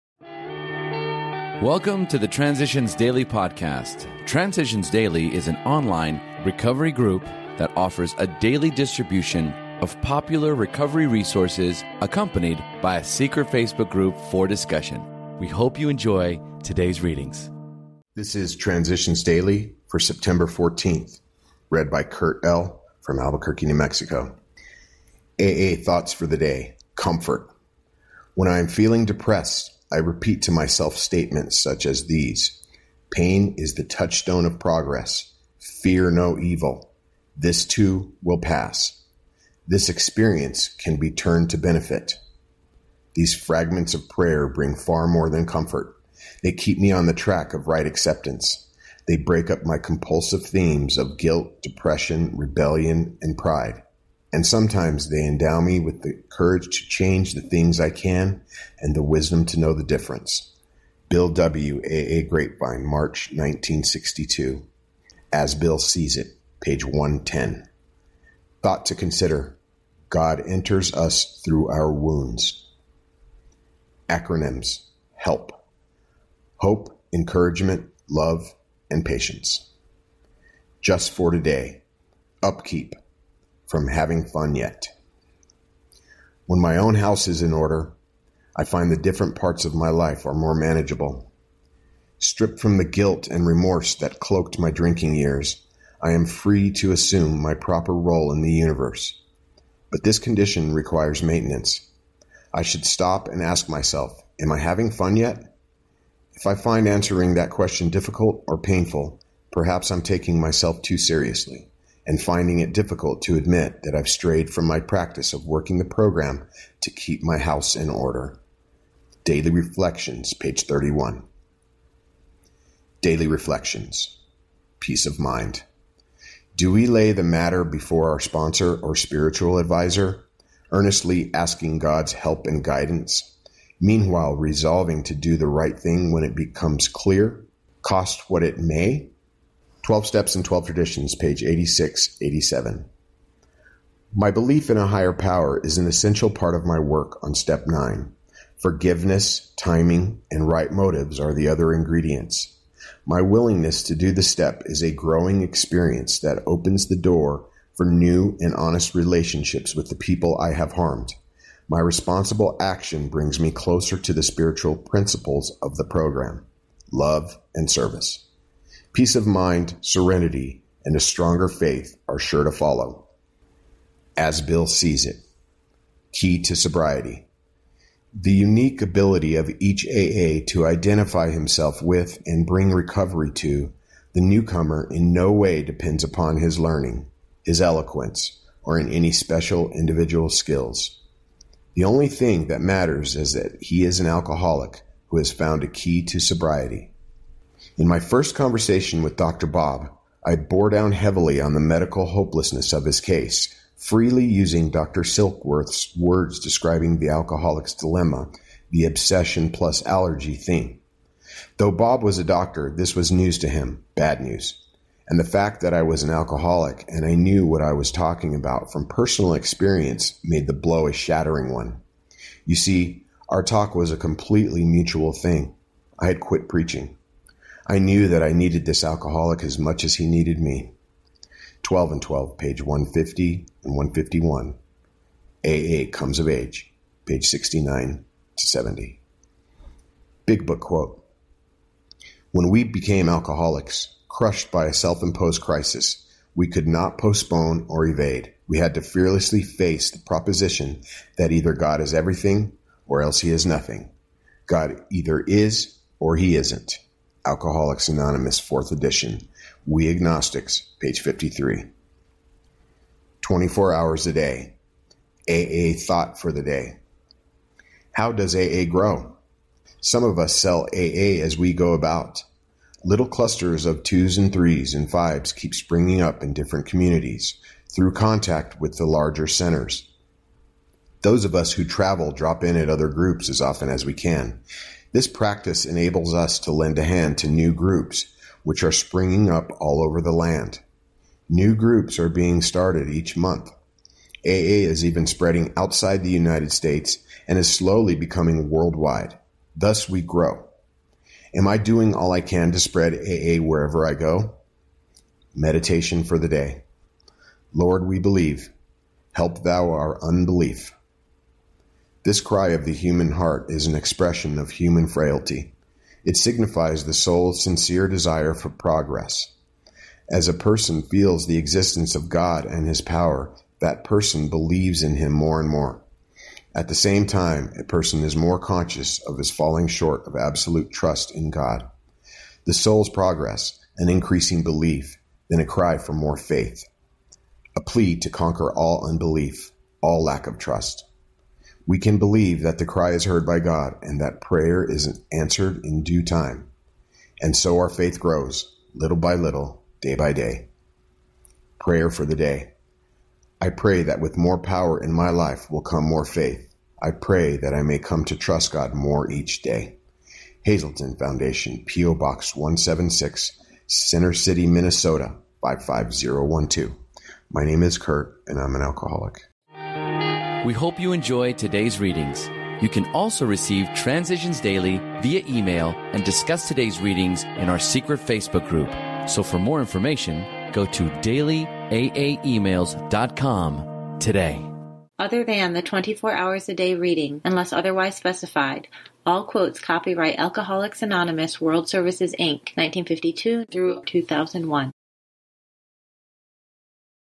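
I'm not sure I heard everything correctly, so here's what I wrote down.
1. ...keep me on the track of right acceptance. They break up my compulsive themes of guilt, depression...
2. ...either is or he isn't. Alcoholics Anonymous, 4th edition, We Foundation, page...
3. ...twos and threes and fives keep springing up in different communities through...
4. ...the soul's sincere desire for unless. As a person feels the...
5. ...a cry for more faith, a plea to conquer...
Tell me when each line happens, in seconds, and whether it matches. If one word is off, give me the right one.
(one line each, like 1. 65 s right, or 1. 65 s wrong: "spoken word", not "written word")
1. 46 s right
2. 254 s wrong: "Agnostics", not "Foundation"
3. 273 s right
4. 316 s wrong: "progress", not "unless"
5. 335 s right.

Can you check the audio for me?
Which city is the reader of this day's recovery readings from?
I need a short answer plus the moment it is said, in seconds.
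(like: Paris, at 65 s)
Albuquerque, New Mexico, at 23 s.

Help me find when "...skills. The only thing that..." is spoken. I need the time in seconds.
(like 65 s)
190 s.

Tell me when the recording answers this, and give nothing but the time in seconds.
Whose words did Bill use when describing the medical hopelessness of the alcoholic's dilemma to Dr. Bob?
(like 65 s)
204 s.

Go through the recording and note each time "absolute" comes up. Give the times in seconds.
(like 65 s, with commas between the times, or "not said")
330 s.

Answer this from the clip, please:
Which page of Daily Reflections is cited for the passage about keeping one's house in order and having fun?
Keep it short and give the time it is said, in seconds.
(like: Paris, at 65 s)
31, at 120 s.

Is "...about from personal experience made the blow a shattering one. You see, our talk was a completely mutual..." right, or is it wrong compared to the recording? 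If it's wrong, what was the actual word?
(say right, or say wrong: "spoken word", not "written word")
right.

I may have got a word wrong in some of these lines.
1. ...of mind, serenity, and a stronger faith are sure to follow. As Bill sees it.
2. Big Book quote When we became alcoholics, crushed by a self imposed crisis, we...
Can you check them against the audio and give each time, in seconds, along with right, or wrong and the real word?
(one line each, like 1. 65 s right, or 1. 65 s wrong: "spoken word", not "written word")
1. 169 s right
2. 240 s right.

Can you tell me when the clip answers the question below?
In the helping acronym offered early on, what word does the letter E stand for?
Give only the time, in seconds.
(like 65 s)
77 s.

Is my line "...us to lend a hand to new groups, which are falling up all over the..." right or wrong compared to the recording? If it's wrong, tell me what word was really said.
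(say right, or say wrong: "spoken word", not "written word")
wrong: "springing", not "falling".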